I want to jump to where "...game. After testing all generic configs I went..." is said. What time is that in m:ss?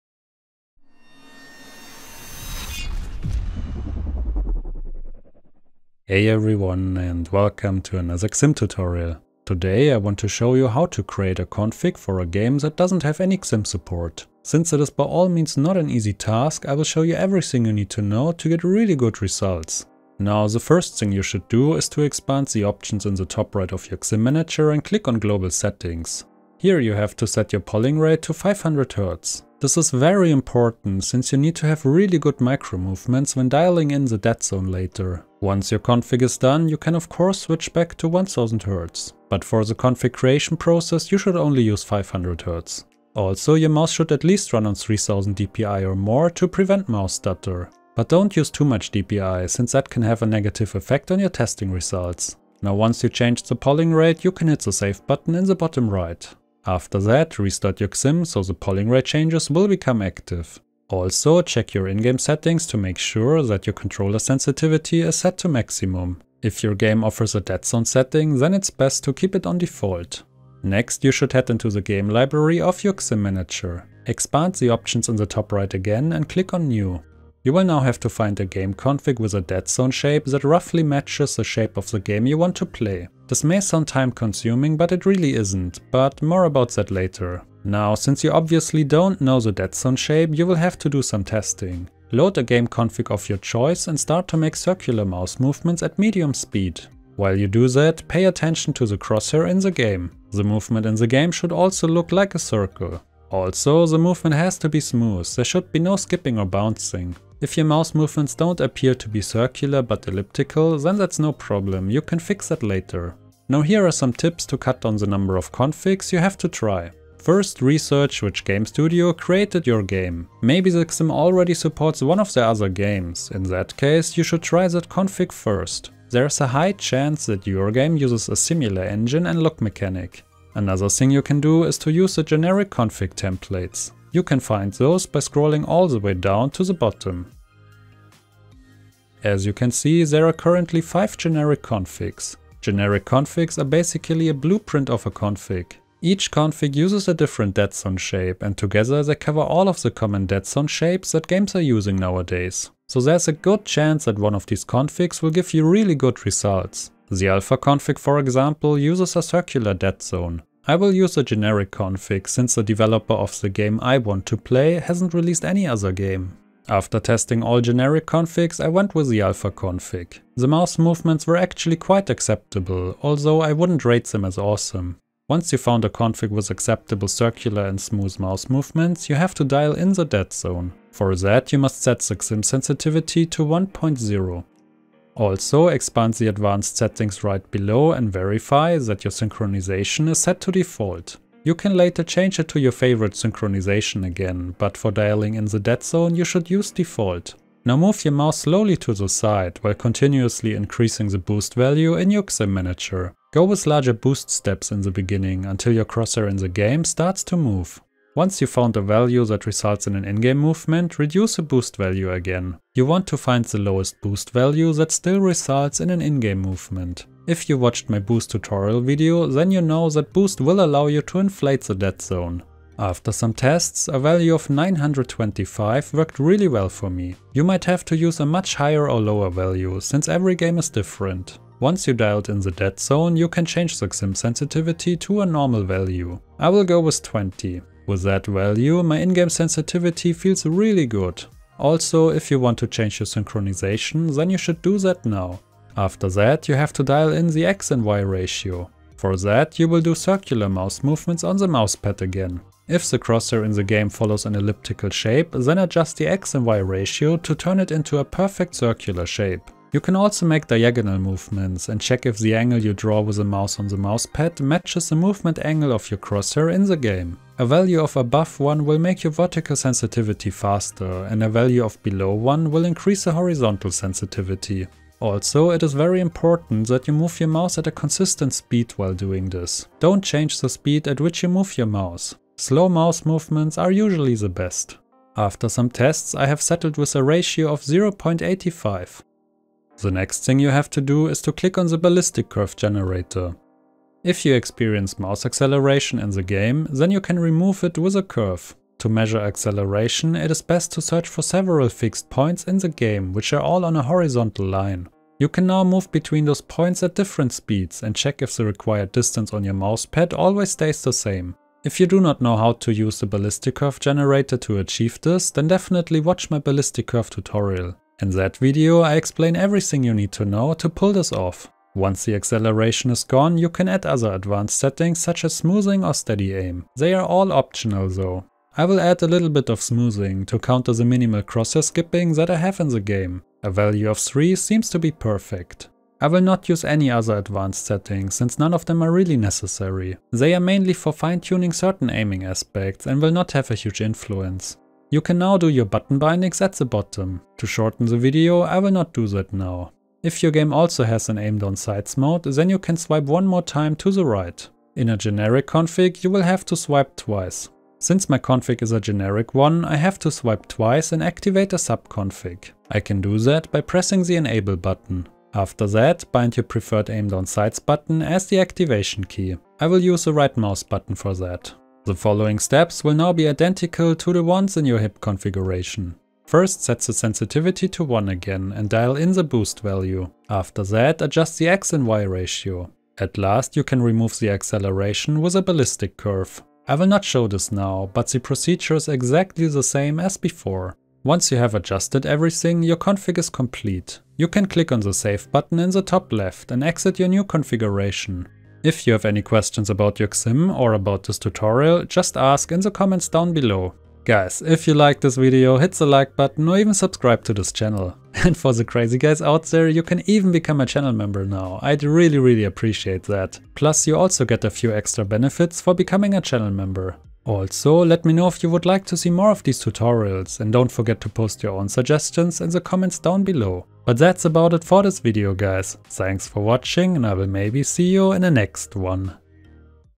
2:45.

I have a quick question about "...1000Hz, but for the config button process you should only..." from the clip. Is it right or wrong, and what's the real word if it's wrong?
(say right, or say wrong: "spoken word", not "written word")
wrong: "creation", not "button".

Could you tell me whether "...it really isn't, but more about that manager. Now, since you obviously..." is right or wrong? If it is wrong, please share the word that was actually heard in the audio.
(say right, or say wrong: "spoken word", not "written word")
wrong: "later", not "manager".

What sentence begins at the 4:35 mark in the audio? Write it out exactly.
Also, it is very important that you move your mouse at a consistent speed while doing this.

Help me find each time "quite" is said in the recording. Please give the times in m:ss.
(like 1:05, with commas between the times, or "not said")
2:51.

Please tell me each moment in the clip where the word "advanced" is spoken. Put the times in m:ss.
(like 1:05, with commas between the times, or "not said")
3:06, 5:24, 5:37.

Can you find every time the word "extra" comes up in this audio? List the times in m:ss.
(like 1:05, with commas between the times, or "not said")
6:54.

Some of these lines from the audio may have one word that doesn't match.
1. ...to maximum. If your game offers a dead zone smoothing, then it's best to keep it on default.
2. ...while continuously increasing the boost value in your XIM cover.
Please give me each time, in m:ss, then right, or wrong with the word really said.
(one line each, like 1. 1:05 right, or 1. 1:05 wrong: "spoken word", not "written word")
1. 1:05 wrong: "setting", not "smoothing"
2. 3:19 wrong: "manager", not "cover".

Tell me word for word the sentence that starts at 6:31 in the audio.
Once you have adjusted everything, your config is complete.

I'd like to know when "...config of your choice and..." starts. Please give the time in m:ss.
1:32.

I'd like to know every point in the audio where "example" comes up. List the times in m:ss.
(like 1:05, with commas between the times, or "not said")
2:38.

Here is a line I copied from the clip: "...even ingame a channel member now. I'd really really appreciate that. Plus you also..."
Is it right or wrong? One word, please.
wrong.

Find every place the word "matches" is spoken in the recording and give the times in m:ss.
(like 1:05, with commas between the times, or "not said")
1:20, 4:24.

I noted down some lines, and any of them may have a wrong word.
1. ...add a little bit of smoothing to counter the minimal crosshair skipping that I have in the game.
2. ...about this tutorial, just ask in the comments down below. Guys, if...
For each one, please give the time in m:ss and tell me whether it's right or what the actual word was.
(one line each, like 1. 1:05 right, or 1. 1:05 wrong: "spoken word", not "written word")
1. 5:28 right
2. 6:40 right.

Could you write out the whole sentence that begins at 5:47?
To shorten the video, I will not do that now.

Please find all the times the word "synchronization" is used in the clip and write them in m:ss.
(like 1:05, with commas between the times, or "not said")
3:09, 3:13, 4:03.